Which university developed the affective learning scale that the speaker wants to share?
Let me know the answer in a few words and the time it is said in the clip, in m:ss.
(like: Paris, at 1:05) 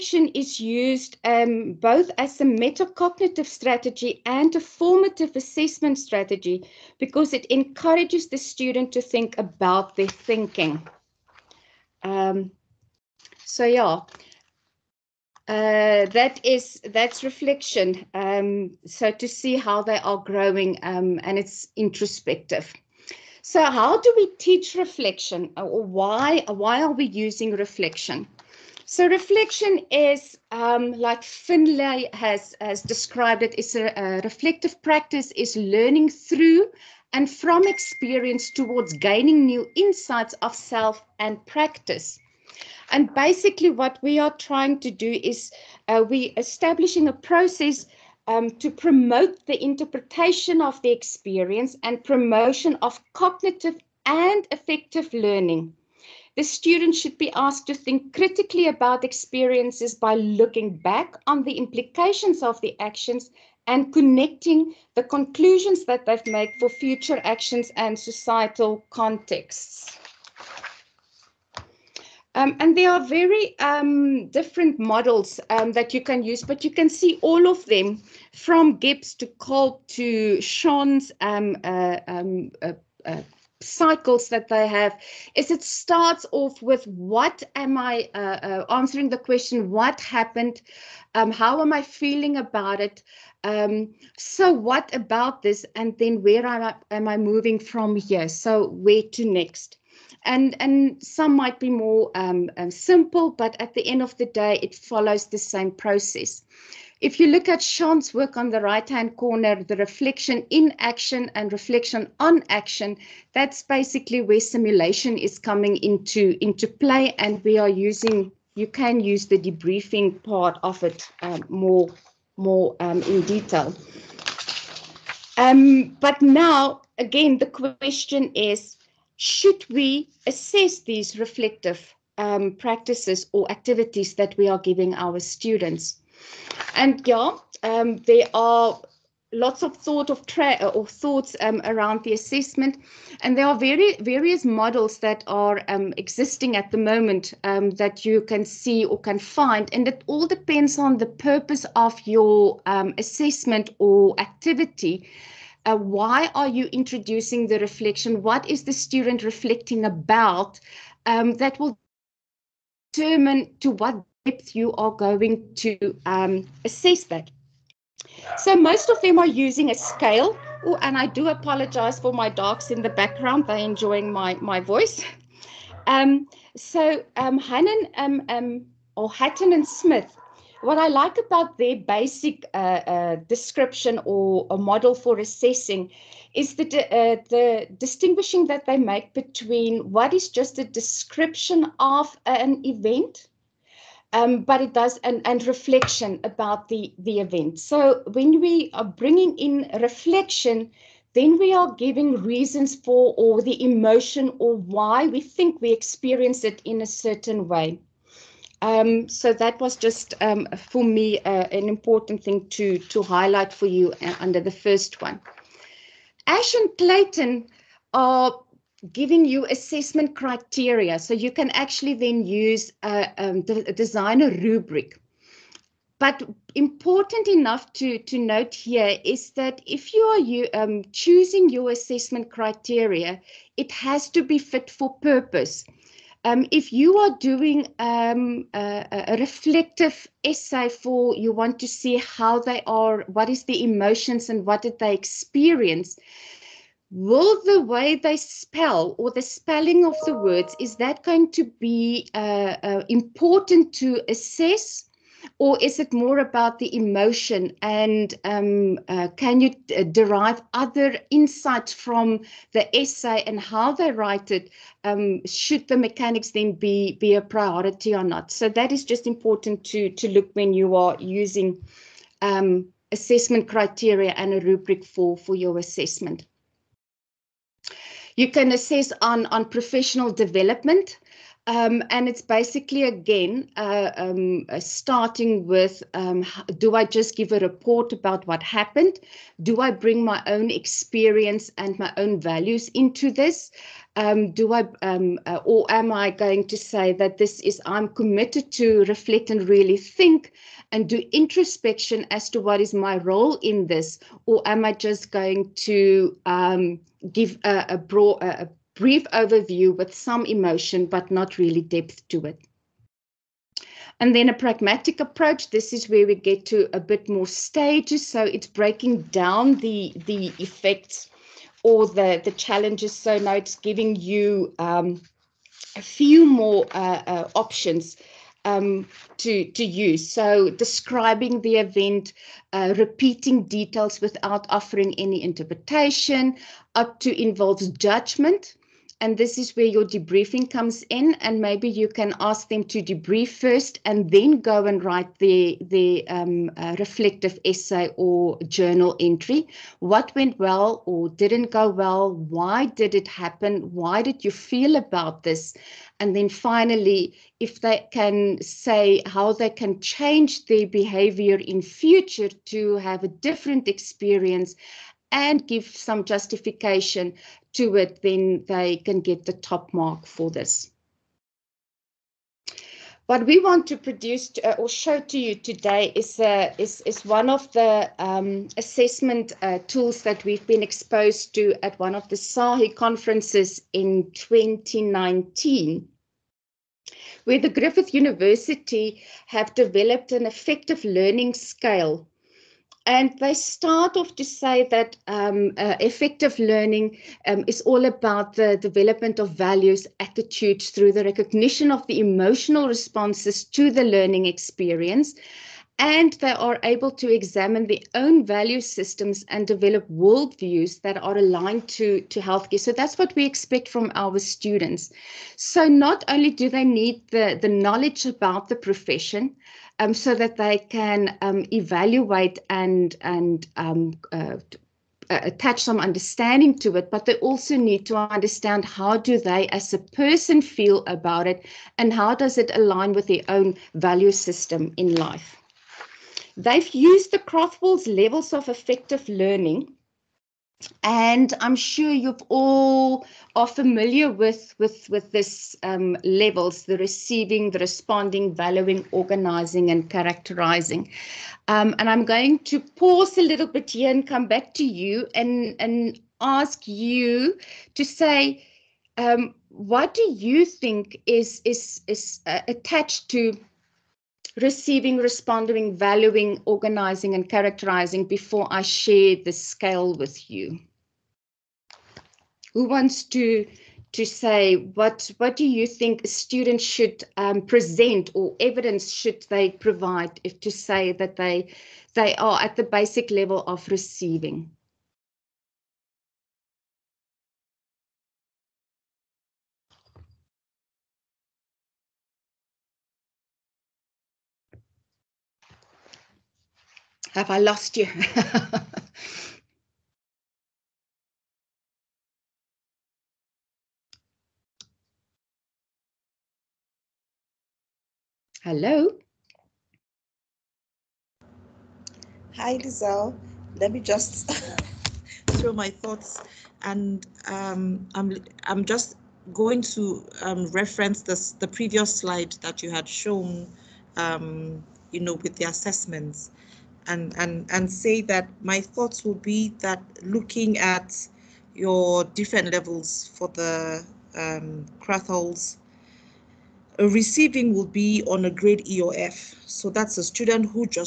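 Griffith University, at 6:27.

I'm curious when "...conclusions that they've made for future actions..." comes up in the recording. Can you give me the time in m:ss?
1:05.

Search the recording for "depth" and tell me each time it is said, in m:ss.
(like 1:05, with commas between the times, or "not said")
2:44, 5:11.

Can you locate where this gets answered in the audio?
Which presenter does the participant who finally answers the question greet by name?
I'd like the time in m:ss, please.
8:32.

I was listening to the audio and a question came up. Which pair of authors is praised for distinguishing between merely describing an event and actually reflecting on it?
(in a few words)
Hatton and Smith.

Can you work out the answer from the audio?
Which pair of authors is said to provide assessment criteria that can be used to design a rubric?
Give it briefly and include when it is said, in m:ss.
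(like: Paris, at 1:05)
Ash and Clayton, at 3:36.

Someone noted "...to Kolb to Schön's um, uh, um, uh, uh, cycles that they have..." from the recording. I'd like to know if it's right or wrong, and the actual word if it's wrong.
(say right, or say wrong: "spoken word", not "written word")
right.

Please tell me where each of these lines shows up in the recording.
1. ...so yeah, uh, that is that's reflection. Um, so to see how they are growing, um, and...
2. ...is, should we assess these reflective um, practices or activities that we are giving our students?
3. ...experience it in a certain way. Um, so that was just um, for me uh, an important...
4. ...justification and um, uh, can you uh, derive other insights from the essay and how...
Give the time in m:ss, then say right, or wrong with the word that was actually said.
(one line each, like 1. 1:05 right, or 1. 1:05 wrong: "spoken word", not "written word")
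1. 0:13 right
2. 2:08 right
3. 3:25 right
4. 4:16 wrong: "emotion", not "justification".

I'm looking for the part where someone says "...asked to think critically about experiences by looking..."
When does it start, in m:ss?
0:57.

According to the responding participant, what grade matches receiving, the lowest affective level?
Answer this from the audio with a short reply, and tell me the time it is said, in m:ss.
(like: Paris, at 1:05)
E or F, at 8:58.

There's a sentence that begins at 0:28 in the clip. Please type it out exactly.
So reflection is um, like Finlay has has described it.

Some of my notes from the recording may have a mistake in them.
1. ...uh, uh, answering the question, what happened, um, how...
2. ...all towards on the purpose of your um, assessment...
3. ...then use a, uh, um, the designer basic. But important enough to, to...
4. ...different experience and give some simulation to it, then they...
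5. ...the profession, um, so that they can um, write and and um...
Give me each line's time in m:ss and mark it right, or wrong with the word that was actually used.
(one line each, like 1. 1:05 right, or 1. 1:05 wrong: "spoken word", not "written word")
1. 1:28 right
2. 2:30 wrong: "depends", not "towards"
3. 3:41 wrong: "rubric", not "basic"
4. 6:03 wrong: "justification", not "simulation"
5. 6:58 wrong: "evaluate", not "write".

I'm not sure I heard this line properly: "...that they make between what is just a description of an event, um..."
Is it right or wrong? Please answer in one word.
right.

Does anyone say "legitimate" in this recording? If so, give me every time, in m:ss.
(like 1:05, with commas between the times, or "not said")
not said.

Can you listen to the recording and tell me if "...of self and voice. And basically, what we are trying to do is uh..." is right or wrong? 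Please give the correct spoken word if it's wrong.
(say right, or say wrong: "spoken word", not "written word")
wrong: "practice", not "voice".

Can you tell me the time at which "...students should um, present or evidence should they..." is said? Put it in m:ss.
7:56.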